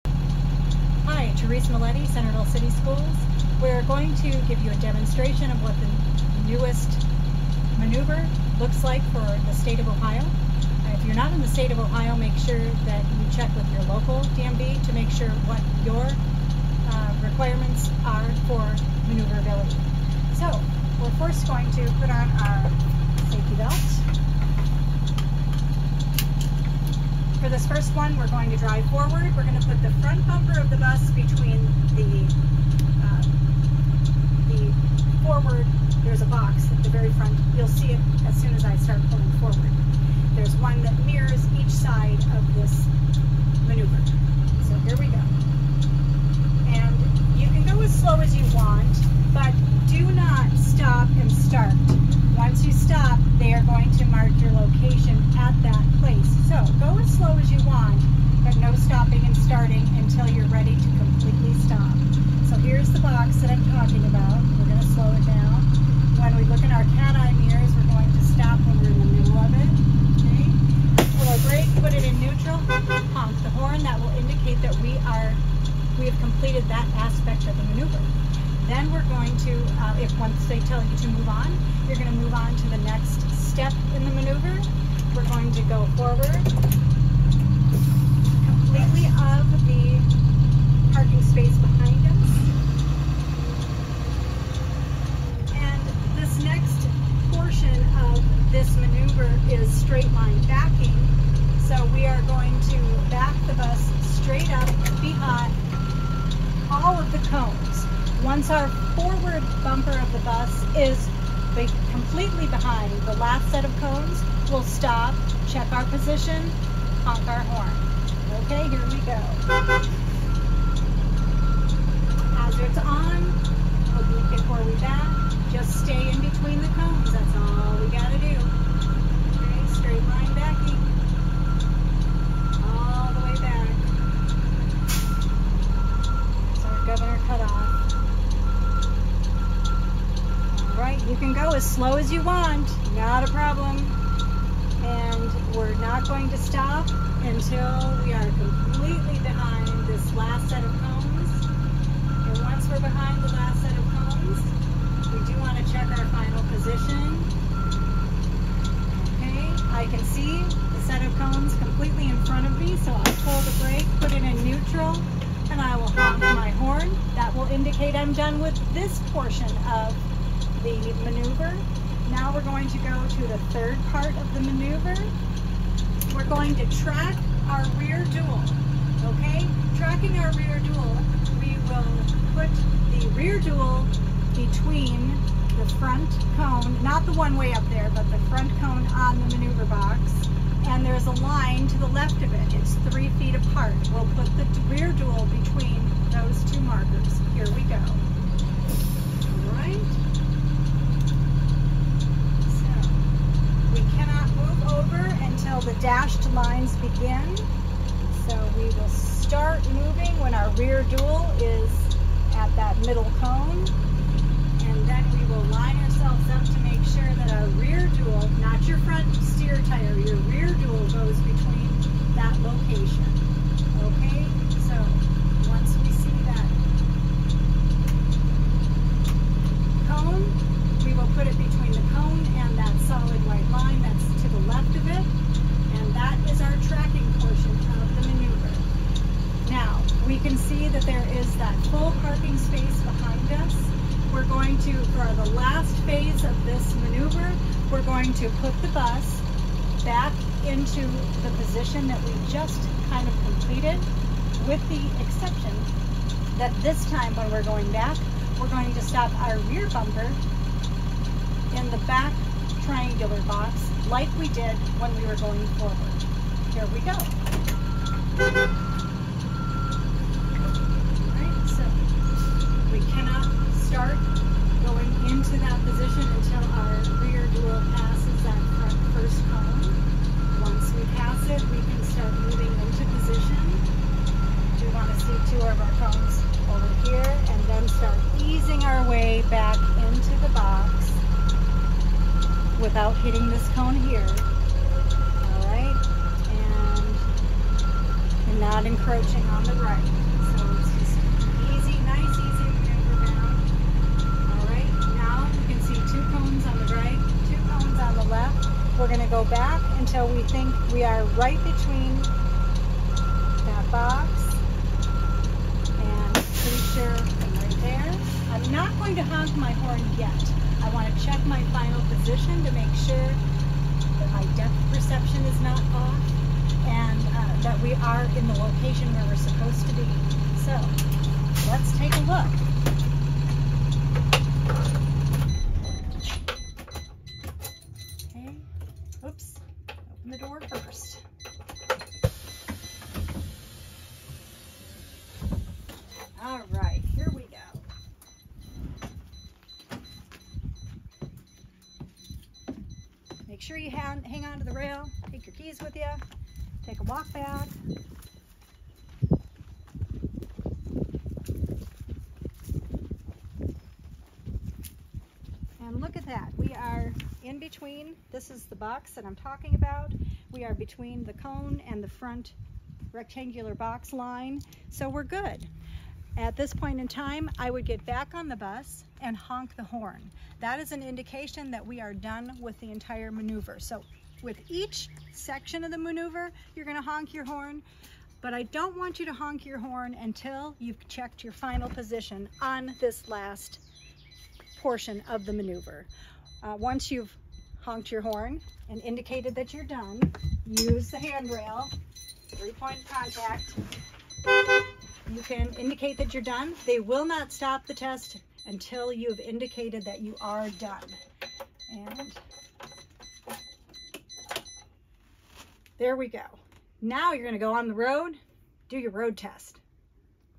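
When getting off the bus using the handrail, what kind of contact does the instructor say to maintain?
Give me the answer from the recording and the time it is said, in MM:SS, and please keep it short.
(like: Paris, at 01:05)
Three-point contact, at 06:42.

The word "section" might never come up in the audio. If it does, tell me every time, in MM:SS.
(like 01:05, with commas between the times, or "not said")
06:25.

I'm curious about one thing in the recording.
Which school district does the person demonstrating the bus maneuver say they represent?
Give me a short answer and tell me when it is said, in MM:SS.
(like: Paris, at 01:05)
Centerville City Schools, at 00:02.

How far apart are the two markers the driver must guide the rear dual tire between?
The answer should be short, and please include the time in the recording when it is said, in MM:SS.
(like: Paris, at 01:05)
3 feet, at 03:12.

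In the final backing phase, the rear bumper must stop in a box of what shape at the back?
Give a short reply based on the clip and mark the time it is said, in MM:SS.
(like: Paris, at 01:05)
Triangular, at 04:22.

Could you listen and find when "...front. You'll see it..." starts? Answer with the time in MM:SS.
00:37.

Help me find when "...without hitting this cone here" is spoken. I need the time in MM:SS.
04:52.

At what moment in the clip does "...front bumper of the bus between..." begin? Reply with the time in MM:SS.
00:29.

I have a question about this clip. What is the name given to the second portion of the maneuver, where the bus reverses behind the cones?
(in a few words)
Straight line backing.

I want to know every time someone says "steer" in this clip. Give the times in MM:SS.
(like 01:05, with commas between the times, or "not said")
03:39.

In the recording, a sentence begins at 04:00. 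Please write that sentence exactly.
can see that there is that full parking space behind us.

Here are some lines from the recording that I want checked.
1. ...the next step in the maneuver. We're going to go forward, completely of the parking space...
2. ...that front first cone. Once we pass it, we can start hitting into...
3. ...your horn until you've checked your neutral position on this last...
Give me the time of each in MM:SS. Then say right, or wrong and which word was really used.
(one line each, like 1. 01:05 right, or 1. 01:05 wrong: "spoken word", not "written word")
1. 01:22 right
2. 04:38 wrong: "moving", not "hitting"
3. 06:29 wrong: "final", not "neutral".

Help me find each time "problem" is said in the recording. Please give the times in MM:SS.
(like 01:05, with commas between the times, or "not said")
02:23.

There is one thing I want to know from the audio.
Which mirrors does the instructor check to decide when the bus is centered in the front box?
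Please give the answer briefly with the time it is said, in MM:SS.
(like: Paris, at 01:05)
Cat eye mirrors, at 01:06.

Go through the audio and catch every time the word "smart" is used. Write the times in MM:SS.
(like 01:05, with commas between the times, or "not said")
not said.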